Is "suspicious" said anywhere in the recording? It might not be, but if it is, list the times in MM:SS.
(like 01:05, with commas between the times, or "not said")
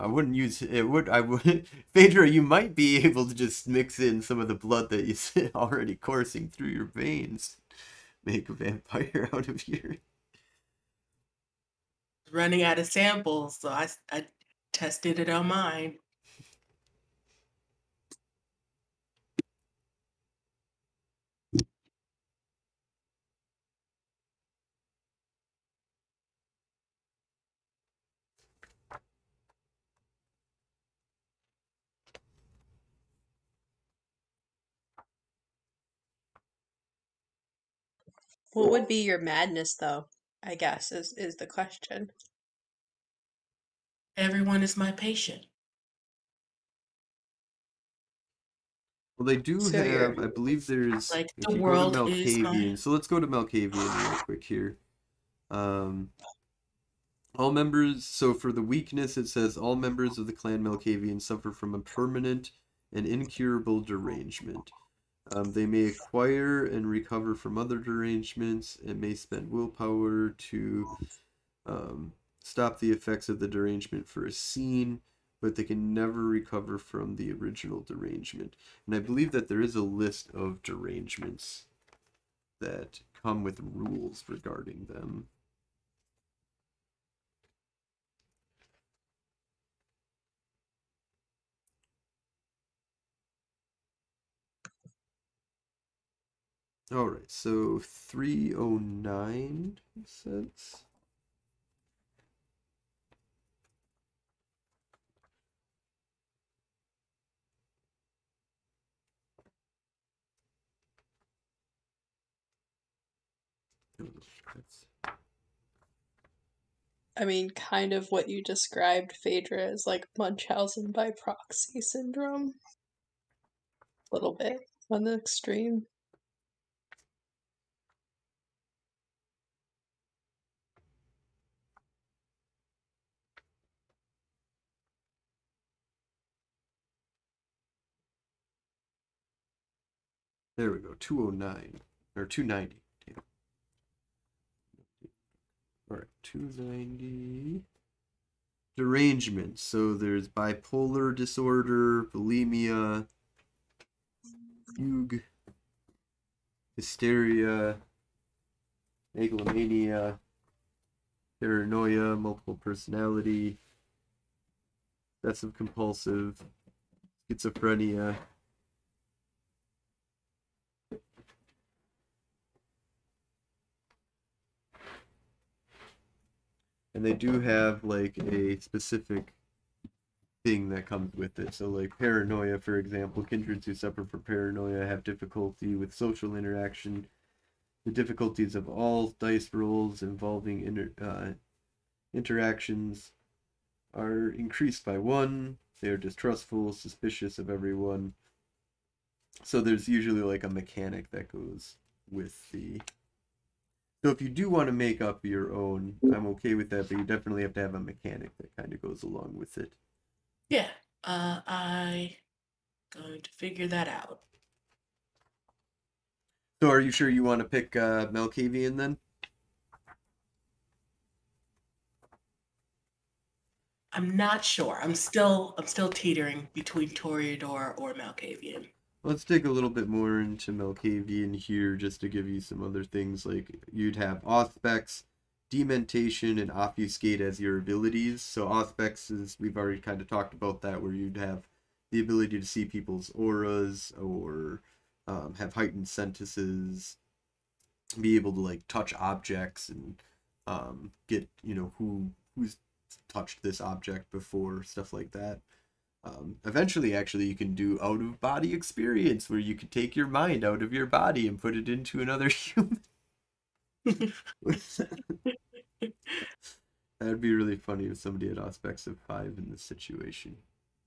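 03:16.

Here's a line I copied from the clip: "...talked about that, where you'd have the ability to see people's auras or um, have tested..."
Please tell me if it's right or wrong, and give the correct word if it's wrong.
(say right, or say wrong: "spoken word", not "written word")
wrong: "heightened", not "tested".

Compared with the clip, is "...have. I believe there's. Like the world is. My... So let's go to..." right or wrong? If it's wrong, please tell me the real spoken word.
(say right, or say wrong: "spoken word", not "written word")
right.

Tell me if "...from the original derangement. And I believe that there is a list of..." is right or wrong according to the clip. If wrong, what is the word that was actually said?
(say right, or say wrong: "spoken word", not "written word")
right.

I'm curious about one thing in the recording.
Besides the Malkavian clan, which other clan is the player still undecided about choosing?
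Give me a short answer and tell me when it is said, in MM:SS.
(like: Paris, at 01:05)
Toreador, at 03:46.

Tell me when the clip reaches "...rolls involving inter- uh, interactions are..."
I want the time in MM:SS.
03:09.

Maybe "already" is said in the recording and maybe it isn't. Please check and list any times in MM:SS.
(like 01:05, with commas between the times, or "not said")
00:05, 03:59.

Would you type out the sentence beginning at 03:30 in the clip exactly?
Yeah, uh, I going to figure that out.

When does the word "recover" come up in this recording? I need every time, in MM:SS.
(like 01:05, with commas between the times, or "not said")
01:06, 01:16.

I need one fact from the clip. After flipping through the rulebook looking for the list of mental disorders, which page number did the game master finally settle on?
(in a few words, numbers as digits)
290.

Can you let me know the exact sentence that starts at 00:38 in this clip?
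What would be your madness though?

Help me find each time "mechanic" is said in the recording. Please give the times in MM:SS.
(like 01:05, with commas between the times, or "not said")
03:20, 03:27.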